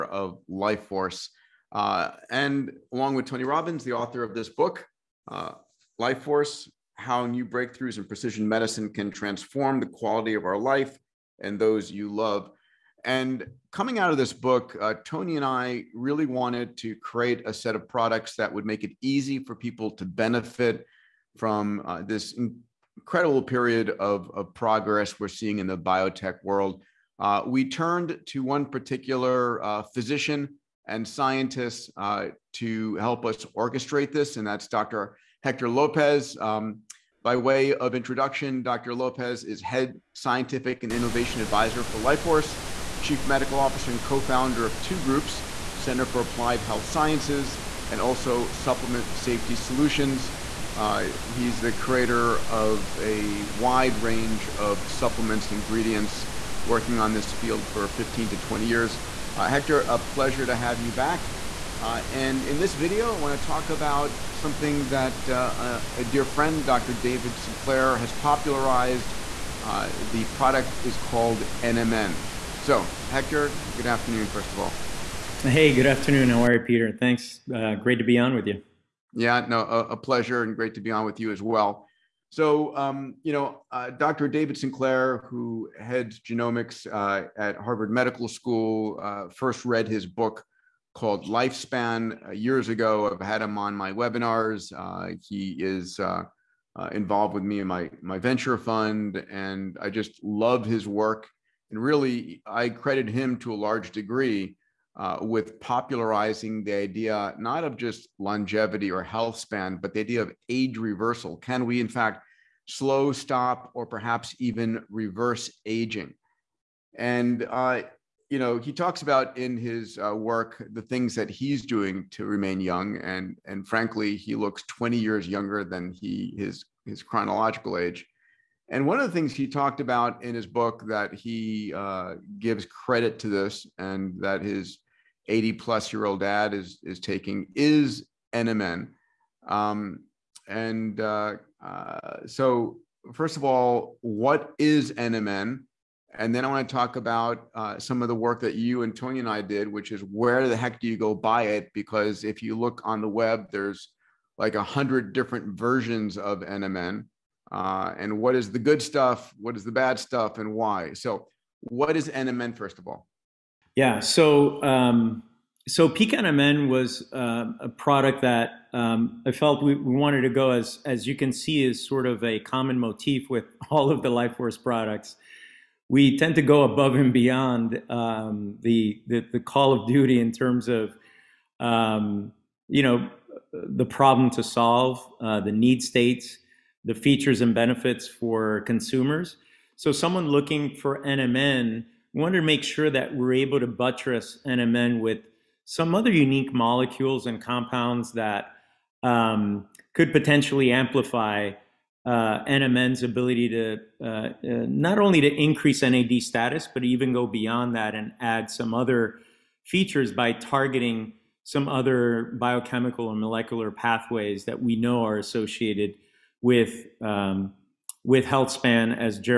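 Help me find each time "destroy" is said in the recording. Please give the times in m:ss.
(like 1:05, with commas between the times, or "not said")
not said.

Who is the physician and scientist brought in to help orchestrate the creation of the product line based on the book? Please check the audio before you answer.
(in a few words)
Dr. Hector Lopez.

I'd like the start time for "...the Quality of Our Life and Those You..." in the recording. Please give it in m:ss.
0:09.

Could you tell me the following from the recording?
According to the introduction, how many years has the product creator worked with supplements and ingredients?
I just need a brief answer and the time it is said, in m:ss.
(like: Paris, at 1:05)
15 to 20 years, at 0:57.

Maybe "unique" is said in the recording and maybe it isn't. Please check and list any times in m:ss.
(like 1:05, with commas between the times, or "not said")
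3:16.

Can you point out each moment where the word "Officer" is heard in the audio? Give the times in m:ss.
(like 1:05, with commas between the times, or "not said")
0:43.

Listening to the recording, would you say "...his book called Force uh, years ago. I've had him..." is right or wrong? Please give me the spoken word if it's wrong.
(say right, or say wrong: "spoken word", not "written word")
wrong: "Lifespan", not "Force".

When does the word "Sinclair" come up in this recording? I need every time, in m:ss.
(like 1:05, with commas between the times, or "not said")
1:07, 1:24.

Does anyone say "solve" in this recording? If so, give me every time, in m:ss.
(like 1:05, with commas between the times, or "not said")
3:04.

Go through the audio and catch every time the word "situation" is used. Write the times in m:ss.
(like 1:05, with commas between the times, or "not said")
not said.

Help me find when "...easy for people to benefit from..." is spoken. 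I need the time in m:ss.
0:19.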